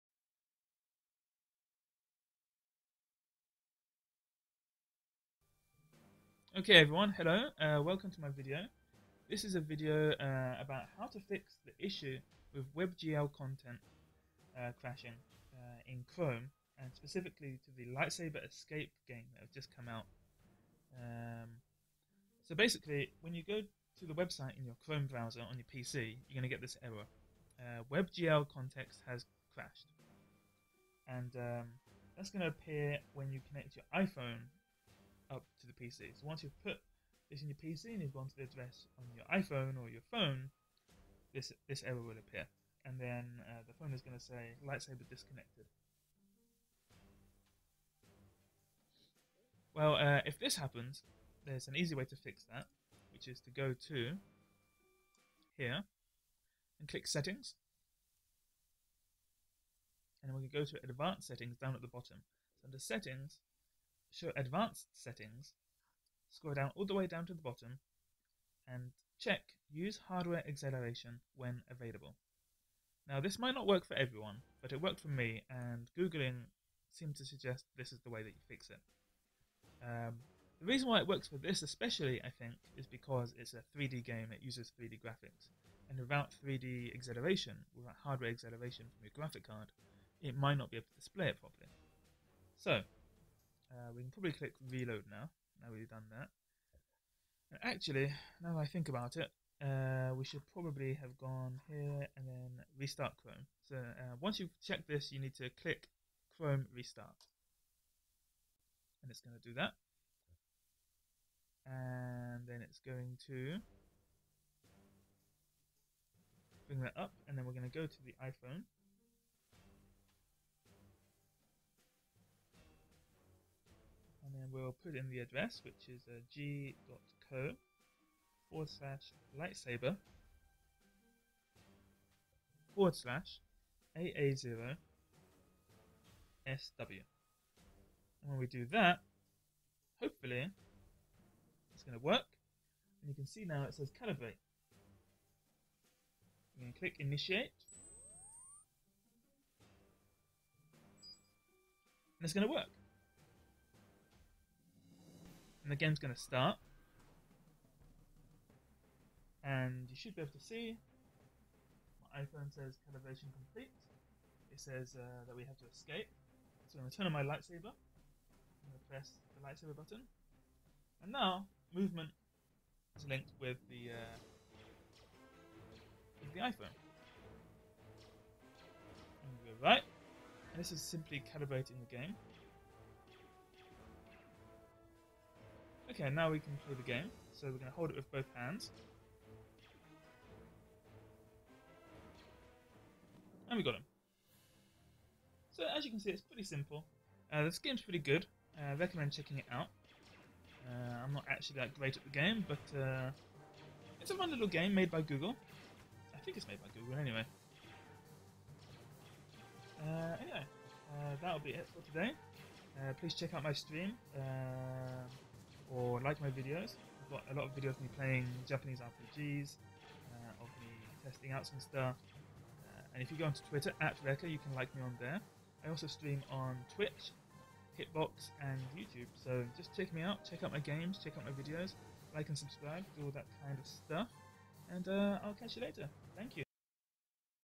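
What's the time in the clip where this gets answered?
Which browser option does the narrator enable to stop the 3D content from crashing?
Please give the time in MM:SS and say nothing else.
01:09.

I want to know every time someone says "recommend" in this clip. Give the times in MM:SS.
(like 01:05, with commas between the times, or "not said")
03:18.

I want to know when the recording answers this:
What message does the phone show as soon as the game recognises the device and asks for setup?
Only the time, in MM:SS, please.
02:23.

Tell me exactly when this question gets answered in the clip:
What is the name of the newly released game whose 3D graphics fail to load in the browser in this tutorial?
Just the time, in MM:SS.
00:17.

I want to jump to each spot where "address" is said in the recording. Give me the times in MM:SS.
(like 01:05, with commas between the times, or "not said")
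00:38, 02:05.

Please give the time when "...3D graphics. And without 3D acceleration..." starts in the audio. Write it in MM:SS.
01:24.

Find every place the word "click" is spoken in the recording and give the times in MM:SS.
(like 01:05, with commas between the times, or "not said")
00:56, 01:34, 01:45, 02:26.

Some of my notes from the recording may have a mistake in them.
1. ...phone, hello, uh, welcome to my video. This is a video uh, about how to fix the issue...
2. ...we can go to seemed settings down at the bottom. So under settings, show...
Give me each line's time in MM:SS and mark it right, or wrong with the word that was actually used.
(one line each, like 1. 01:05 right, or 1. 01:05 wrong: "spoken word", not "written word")
1. 00:06 wrong: "everyone", not "phone"
2. 01:00 wrong: "advanced", not "seemed".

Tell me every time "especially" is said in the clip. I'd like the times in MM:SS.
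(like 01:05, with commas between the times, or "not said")
01:21.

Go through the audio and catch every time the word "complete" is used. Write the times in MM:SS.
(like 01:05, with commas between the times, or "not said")
02:43.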